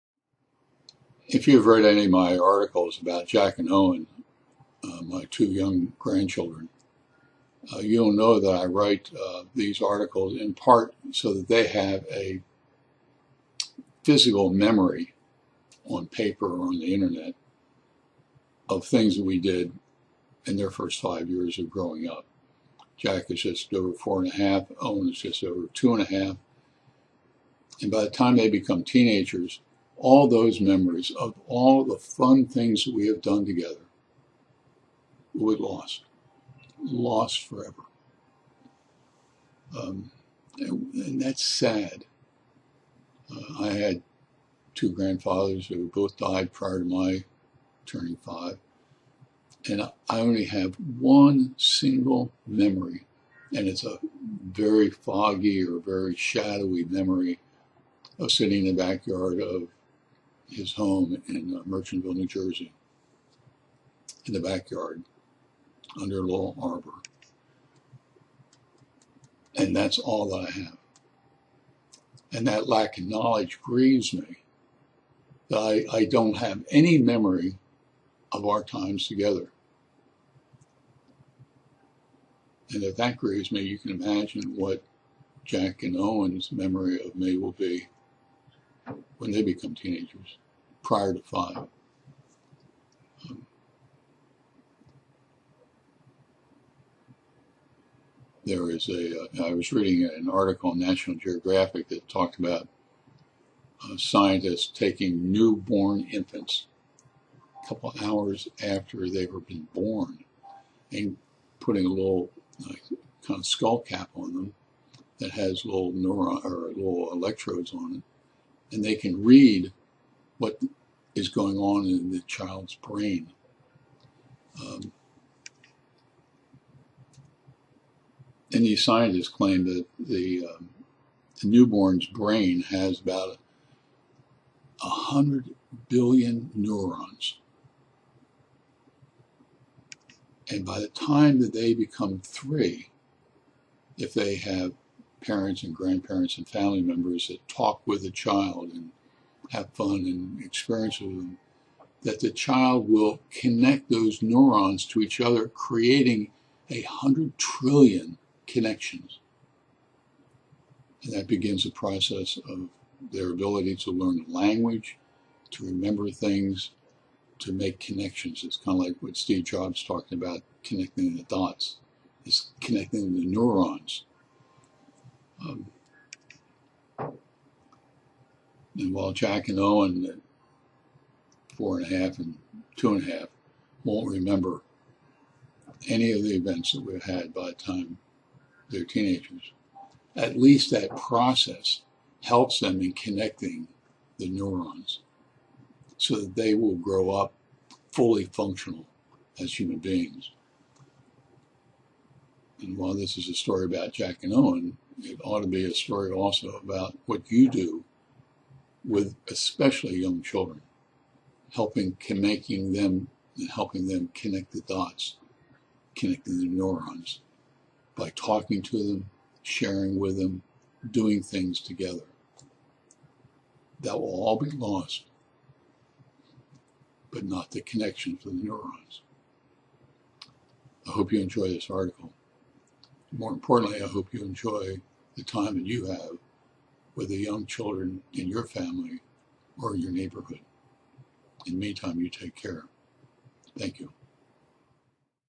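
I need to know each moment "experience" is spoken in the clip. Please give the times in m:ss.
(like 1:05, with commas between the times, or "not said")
2:30.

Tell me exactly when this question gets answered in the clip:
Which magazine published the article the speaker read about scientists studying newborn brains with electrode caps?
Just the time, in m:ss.
1:40.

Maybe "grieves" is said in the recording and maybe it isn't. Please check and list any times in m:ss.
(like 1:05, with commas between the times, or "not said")
1:13, 1:23.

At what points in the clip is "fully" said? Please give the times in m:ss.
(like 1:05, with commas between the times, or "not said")
3:17.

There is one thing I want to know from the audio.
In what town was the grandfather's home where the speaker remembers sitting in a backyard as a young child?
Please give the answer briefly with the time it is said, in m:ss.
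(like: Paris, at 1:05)
Merchantville, New Jersey, at 1:01.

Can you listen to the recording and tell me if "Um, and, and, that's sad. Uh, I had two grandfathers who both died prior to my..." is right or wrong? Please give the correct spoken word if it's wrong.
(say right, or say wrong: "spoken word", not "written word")
right.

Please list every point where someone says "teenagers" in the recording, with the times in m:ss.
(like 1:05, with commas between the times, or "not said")
0:28, 1:29, 3:08.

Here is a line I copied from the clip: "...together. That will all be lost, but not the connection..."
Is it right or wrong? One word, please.
right.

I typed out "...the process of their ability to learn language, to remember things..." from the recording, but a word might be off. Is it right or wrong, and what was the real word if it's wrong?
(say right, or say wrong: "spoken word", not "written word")
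right.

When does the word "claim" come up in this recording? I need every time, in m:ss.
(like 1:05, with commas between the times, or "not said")
2:09.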